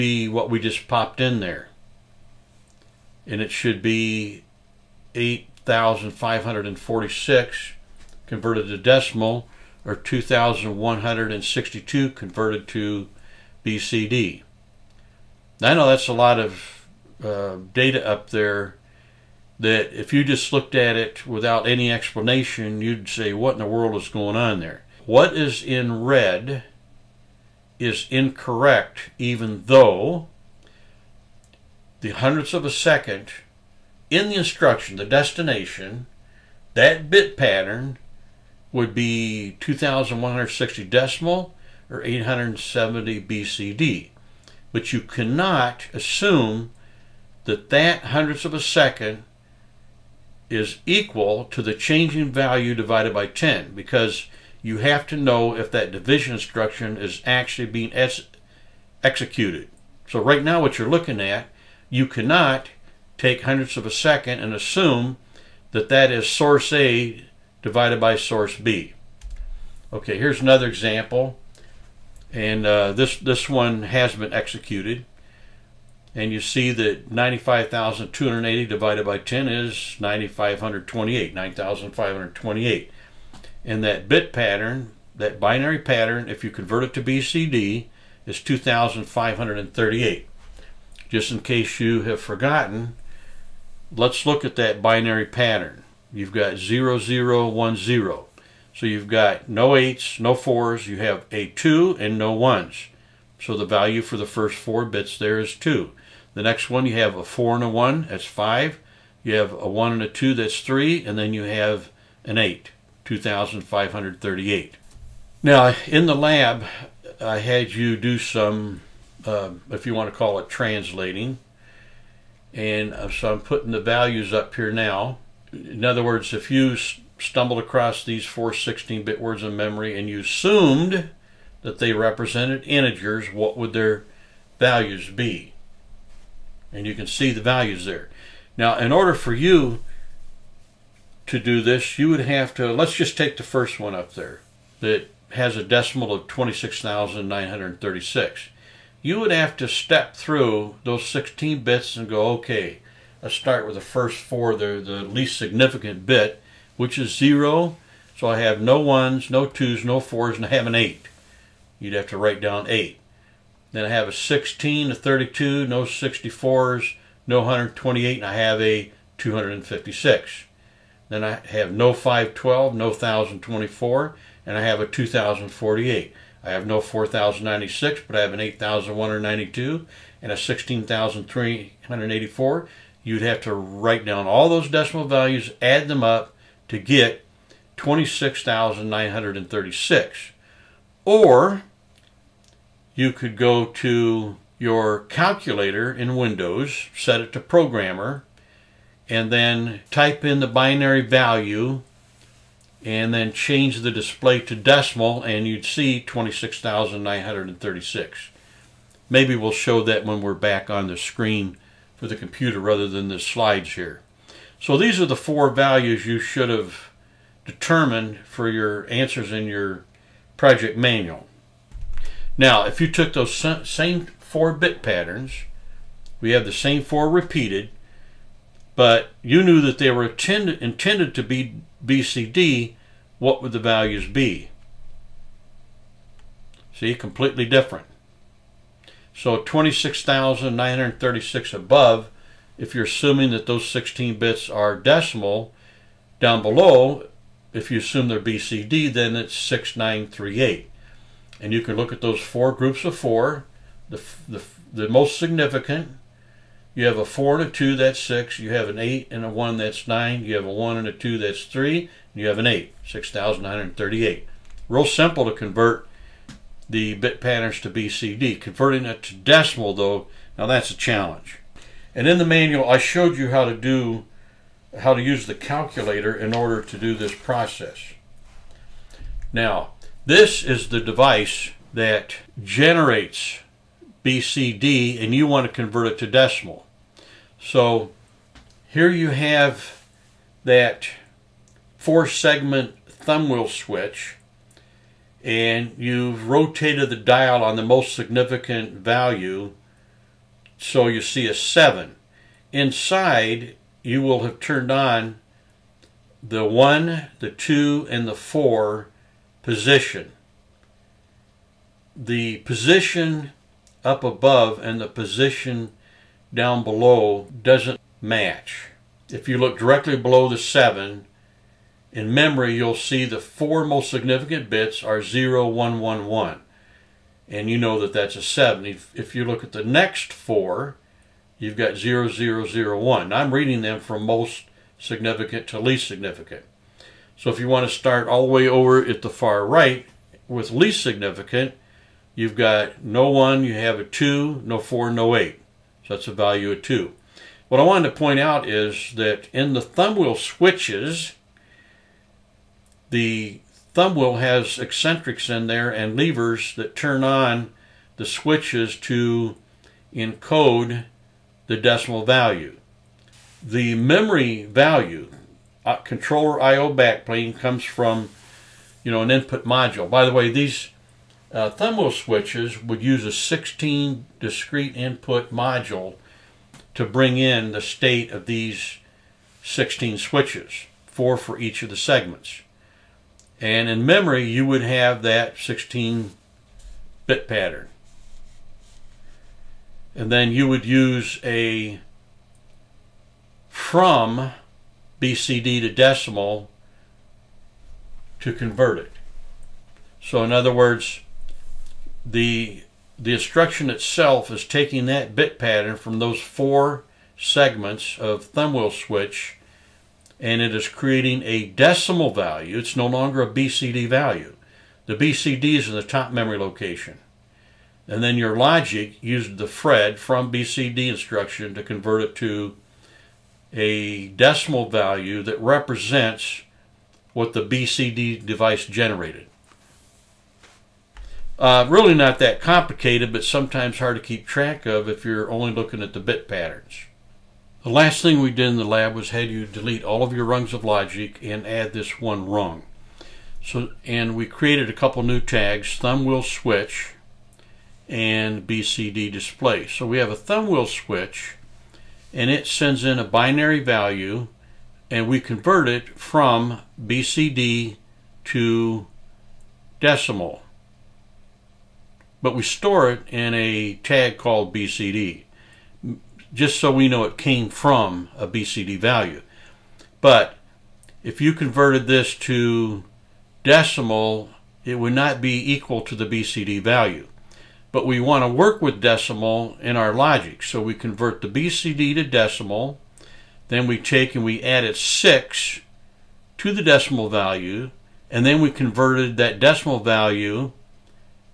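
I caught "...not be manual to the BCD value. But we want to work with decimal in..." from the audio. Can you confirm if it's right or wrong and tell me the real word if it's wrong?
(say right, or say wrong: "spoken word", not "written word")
wrong: "equal", not "manual".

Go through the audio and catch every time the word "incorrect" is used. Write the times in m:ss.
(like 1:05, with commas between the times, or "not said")
0:28.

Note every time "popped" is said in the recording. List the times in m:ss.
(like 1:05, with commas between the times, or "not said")
0:00.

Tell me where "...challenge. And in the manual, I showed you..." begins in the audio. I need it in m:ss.
4:30.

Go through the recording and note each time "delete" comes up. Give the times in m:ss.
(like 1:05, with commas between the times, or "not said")
7:19.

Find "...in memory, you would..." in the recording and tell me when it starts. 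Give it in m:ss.
6:23.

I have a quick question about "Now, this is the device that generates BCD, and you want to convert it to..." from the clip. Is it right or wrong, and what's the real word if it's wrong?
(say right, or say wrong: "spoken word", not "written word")
right.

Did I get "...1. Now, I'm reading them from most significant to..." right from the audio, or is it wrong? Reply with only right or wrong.
right.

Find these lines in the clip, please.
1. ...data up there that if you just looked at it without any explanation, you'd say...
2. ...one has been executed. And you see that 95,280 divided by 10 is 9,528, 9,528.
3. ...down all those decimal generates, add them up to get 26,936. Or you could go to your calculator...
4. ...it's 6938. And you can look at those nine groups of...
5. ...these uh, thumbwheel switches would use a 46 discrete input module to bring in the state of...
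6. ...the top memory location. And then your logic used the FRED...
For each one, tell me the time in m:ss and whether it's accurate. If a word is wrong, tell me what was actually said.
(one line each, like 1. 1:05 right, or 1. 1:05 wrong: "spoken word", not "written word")
1. 0:17 right
2. 1:13 right
3. 3:04 wrong: "values", not "generates"
4. 4:09 wrong: "four", not "nine"
5. 6:10 wrong: "16", not "46"
6. 6:55 right.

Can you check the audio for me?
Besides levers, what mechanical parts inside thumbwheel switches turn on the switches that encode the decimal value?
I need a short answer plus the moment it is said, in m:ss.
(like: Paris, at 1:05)
eccentrics, at 5:54.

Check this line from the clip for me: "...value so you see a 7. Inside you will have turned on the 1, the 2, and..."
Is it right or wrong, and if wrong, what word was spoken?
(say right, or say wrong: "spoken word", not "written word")
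right.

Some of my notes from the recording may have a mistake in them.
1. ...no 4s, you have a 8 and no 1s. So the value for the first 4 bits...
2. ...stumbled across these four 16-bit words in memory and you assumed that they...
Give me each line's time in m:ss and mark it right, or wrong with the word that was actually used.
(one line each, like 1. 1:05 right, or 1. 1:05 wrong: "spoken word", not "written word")
1. 1:40 wrong: "2", not "8"
2. 2:06 right.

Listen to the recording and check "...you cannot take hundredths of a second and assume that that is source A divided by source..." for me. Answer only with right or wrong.
right.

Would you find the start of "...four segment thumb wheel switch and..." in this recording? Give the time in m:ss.
4:51.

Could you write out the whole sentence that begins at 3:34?
So these are the four values you should have determined for your answers in your project manual.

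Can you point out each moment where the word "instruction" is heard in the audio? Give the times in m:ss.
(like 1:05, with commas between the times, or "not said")
0:34, 0:56, 6:43, 7:00.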